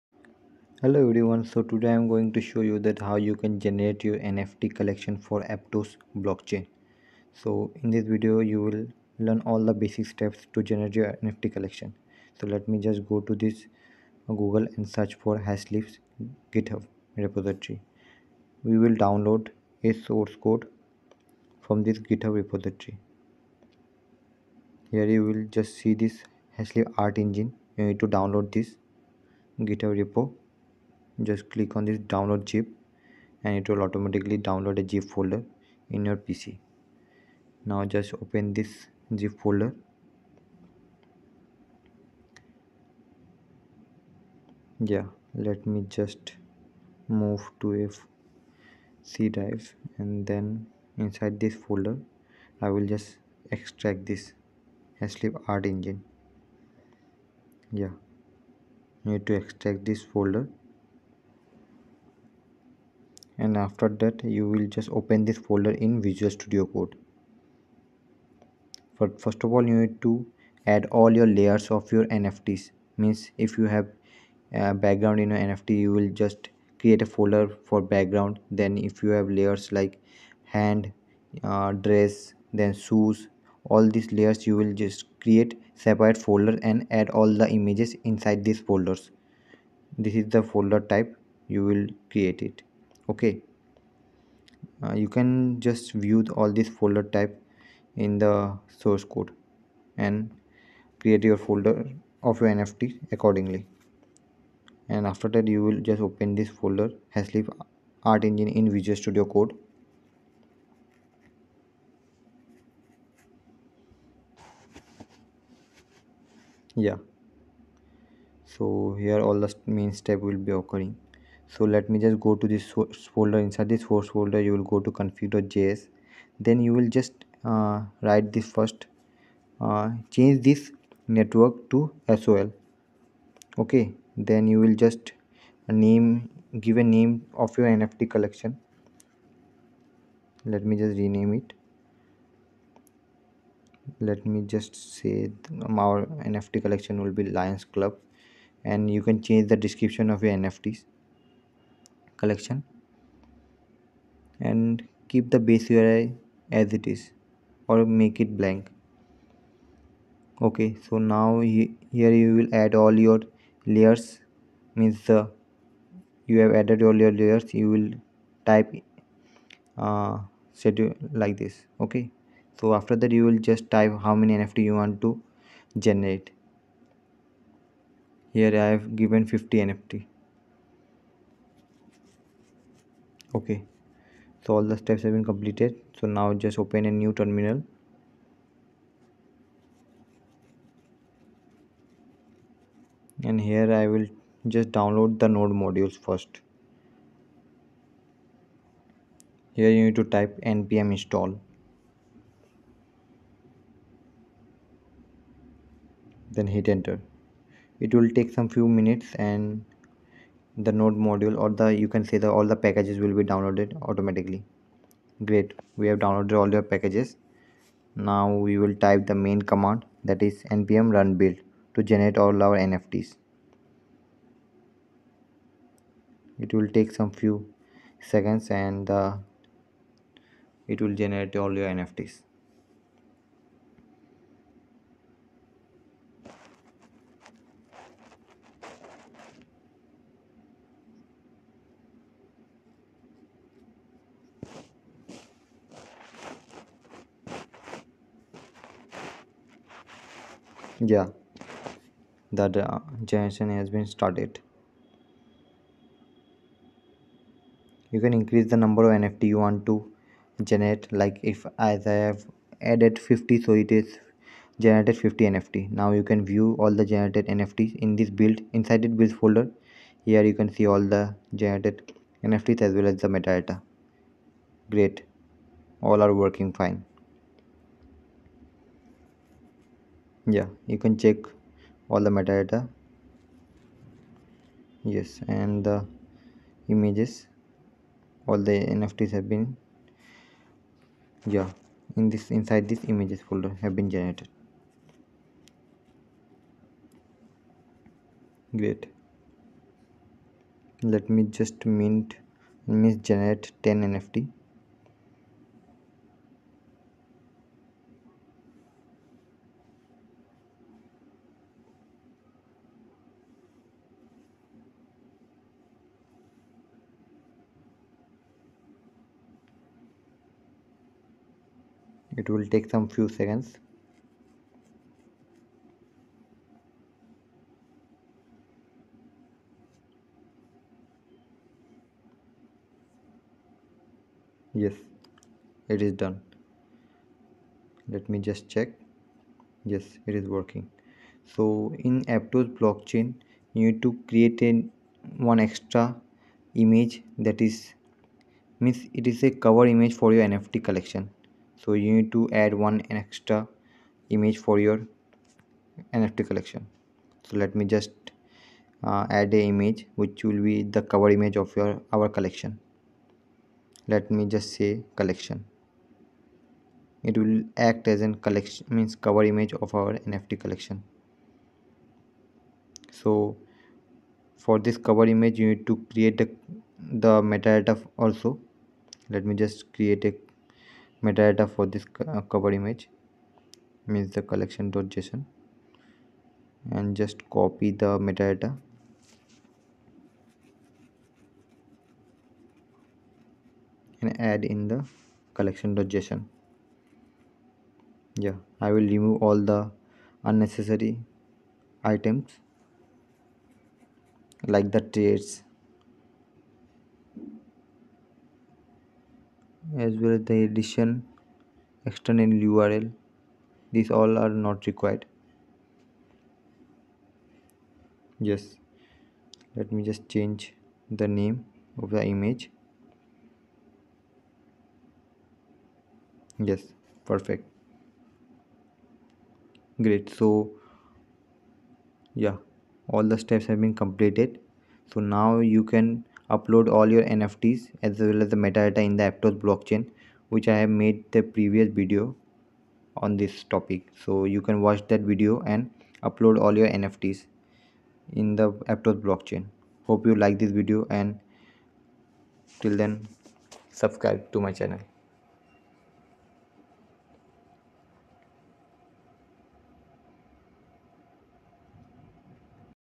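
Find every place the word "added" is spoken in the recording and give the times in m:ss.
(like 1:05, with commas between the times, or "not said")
2:46, 4:22.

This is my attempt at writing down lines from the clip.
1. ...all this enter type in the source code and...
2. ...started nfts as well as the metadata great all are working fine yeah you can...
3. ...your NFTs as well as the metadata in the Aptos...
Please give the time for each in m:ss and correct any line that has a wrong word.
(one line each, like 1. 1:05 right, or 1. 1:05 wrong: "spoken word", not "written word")
1. 1:36 wrong: "folder", not "enter"
2. 4:31 wrong: "generated", not "started"
3. 7:16 right.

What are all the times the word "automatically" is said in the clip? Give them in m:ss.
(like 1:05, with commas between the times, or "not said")
0:33, 3:33.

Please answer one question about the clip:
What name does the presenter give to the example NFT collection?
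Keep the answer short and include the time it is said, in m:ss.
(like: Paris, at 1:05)
Lions Club, at 2:27.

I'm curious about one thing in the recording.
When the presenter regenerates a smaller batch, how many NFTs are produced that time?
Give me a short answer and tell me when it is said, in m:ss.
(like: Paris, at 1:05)
10, at 5:03.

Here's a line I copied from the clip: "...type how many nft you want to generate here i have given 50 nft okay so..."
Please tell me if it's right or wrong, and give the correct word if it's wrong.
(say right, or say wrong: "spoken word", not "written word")
right.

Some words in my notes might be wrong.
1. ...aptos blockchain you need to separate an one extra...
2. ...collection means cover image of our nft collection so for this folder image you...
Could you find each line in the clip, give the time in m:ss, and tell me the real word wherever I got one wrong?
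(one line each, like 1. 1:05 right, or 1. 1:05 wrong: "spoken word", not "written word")
1. 5:42 wrong: "create", not "separate"
2. 6:08 wrong: "cover", not "folder".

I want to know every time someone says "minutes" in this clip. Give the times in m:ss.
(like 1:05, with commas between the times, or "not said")
3:28.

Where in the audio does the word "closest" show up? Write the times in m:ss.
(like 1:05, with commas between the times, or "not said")
not said.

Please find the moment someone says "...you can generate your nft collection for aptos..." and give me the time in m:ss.
0:03.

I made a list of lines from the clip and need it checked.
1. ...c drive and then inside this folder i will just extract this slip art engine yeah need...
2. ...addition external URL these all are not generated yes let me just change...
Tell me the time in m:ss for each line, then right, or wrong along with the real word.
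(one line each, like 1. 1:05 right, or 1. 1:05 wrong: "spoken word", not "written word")
1. 0:49 right
2. 6:50 wrong: "required", not "generated".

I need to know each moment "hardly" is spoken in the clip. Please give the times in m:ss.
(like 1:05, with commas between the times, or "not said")
not said.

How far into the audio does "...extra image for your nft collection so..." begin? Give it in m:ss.
5:52.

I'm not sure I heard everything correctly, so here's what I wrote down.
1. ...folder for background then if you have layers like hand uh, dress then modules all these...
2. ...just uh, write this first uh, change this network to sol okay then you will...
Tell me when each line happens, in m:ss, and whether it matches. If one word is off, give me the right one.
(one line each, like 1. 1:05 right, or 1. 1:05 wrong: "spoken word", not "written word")
1. 1:17 wrong: "shoes", not "modules"
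2. 2:06 right.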